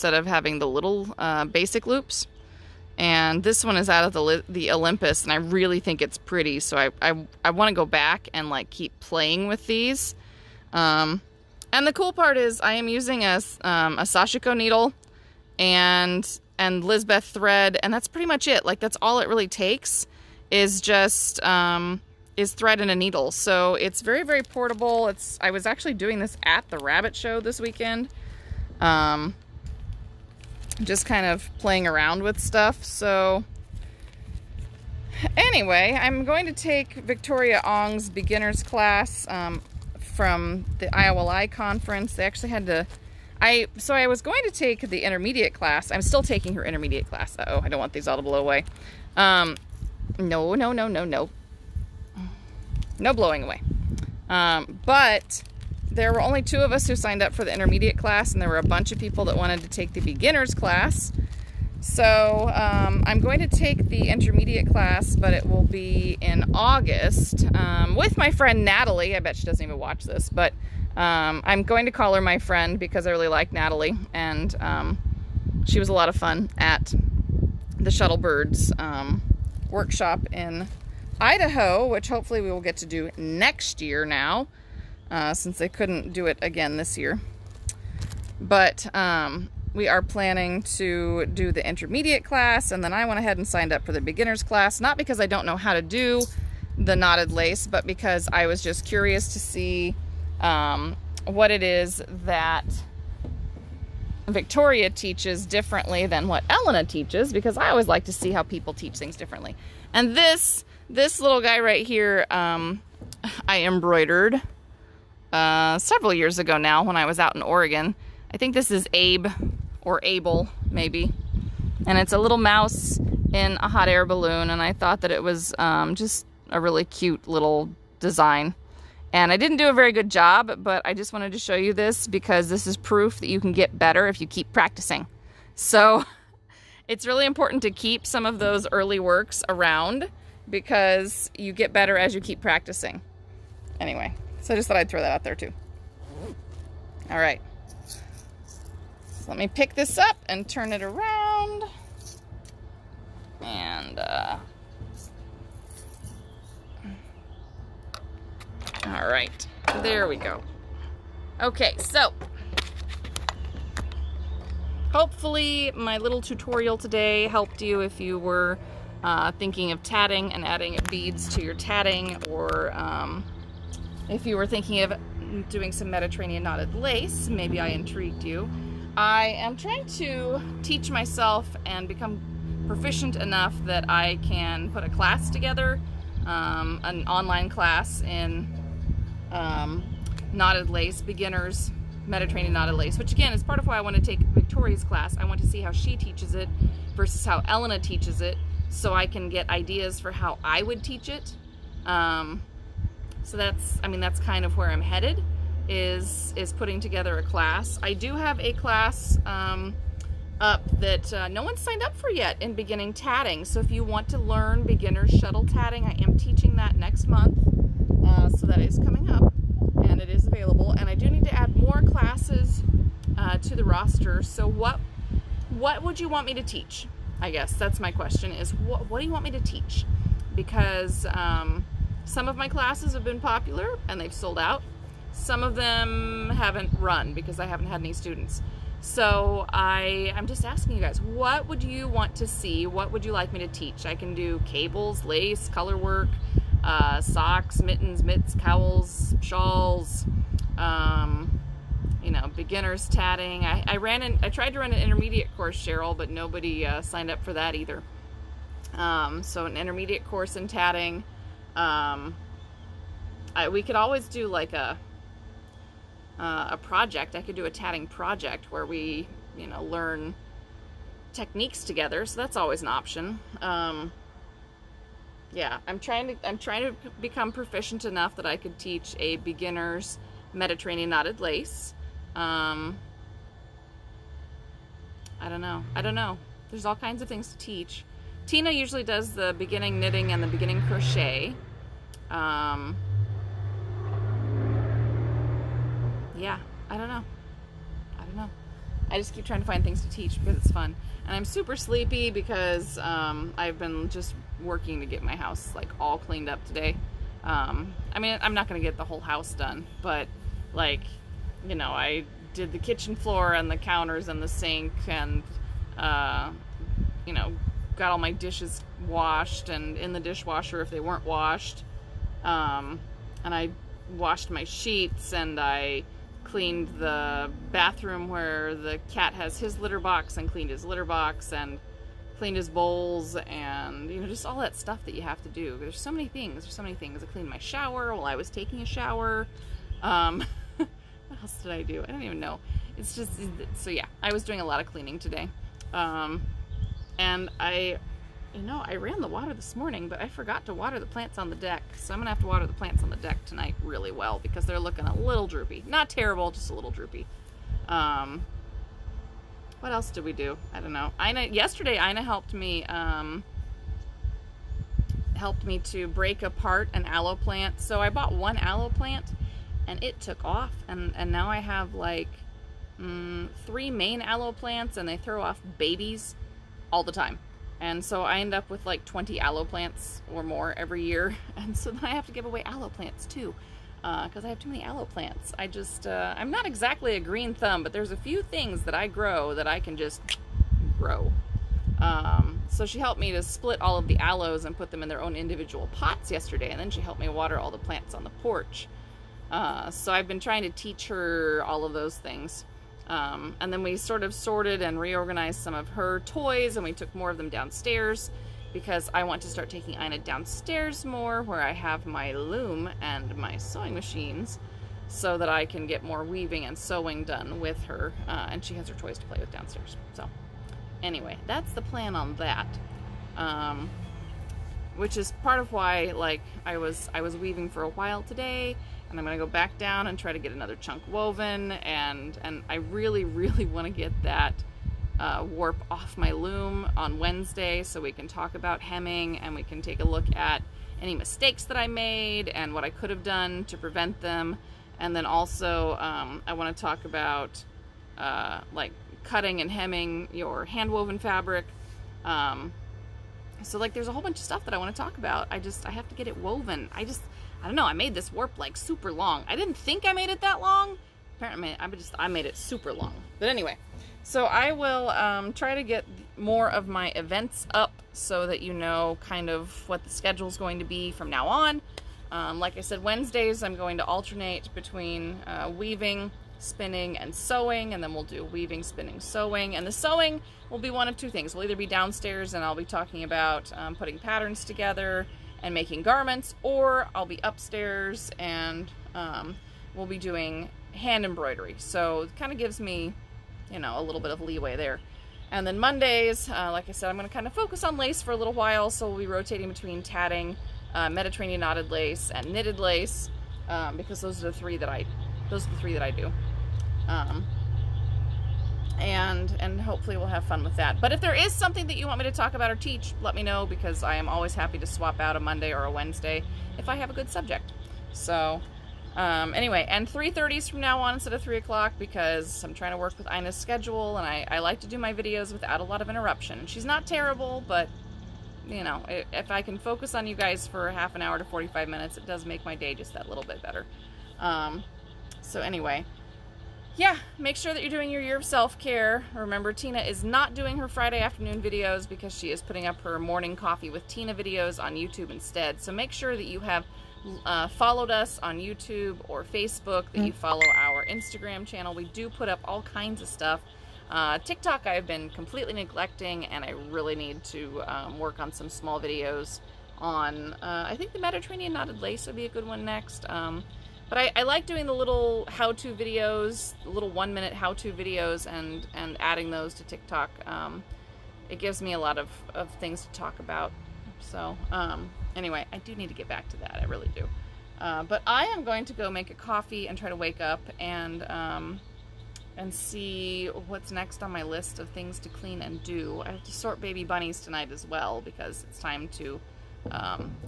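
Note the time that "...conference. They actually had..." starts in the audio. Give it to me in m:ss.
0:41.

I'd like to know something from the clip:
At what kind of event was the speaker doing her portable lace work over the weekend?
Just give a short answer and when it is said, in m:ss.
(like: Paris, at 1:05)
rabbit show, at 0:26.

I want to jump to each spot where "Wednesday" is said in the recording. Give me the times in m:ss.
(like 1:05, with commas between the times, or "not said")
7:16, 7:52, 8:35.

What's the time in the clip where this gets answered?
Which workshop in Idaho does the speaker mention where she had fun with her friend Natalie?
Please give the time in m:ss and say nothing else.
1:17.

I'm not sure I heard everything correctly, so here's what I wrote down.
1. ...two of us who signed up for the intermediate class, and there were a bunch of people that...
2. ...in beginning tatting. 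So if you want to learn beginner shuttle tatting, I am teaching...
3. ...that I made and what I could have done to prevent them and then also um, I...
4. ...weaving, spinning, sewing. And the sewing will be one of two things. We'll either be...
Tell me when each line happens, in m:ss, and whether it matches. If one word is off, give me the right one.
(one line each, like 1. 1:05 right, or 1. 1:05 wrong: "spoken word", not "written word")
1. 0:56 right
2. 3:32 right
3. 7:21 right
4. 7:58 right.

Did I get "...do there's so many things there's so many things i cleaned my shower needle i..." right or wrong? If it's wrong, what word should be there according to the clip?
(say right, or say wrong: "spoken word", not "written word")
wrong: "while", not "needle".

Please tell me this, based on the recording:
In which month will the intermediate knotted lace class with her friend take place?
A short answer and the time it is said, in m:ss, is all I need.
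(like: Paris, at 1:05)
August, at 1:06.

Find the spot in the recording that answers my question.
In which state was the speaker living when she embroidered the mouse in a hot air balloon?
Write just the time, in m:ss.
1:57.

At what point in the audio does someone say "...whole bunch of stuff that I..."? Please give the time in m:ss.
7:33.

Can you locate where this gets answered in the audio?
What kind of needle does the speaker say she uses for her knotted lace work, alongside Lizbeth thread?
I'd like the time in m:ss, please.
0:14.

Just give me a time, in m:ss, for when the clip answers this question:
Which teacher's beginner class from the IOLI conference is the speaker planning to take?
0:36.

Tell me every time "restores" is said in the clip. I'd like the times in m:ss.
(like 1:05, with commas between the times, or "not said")
not said.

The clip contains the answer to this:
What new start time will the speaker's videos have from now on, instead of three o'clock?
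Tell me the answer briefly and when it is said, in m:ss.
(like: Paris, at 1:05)
3:30, at 8:39.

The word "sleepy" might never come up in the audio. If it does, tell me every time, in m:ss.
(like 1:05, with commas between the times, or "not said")
5:01.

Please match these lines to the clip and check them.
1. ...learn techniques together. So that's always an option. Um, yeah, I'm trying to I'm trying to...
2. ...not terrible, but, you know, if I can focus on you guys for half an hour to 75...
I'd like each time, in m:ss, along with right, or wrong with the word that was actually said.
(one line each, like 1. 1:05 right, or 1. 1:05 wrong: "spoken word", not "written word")
1. 4:29 right
2. 8:46 wrong: "45", not "75".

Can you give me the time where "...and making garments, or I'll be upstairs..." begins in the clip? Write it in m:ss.
8:05.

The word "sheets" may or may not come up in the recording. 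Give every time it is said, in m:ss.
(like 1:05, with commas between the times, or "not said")
5:24.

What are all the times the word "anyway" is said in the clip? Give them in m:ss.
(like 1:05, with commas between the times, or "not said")
0:35, 2:23, 7:00, 7:43, 8:39, 8:55, 9:35.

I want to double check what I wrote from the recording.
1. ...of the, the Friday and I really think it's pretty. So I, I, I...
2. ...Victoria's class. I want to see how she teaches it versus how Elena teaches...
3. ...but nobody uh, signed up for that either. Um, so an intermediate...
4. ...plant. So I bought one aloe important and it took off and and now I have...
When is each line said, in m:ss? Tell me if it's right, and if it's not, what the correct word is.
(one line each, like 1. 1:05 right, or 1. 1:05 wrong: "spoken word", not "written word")
1. 0:04 wrong: "Olympus", not "Friday"
2. 3:14 right
3. 4:15 right
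4. 6:07 wrong: "plant", not "important".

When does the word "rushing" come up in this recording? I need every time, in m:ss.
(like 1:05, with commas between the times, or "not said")
not said.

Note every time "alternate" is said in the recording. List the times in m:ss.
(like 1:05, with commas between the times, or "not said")
7:53.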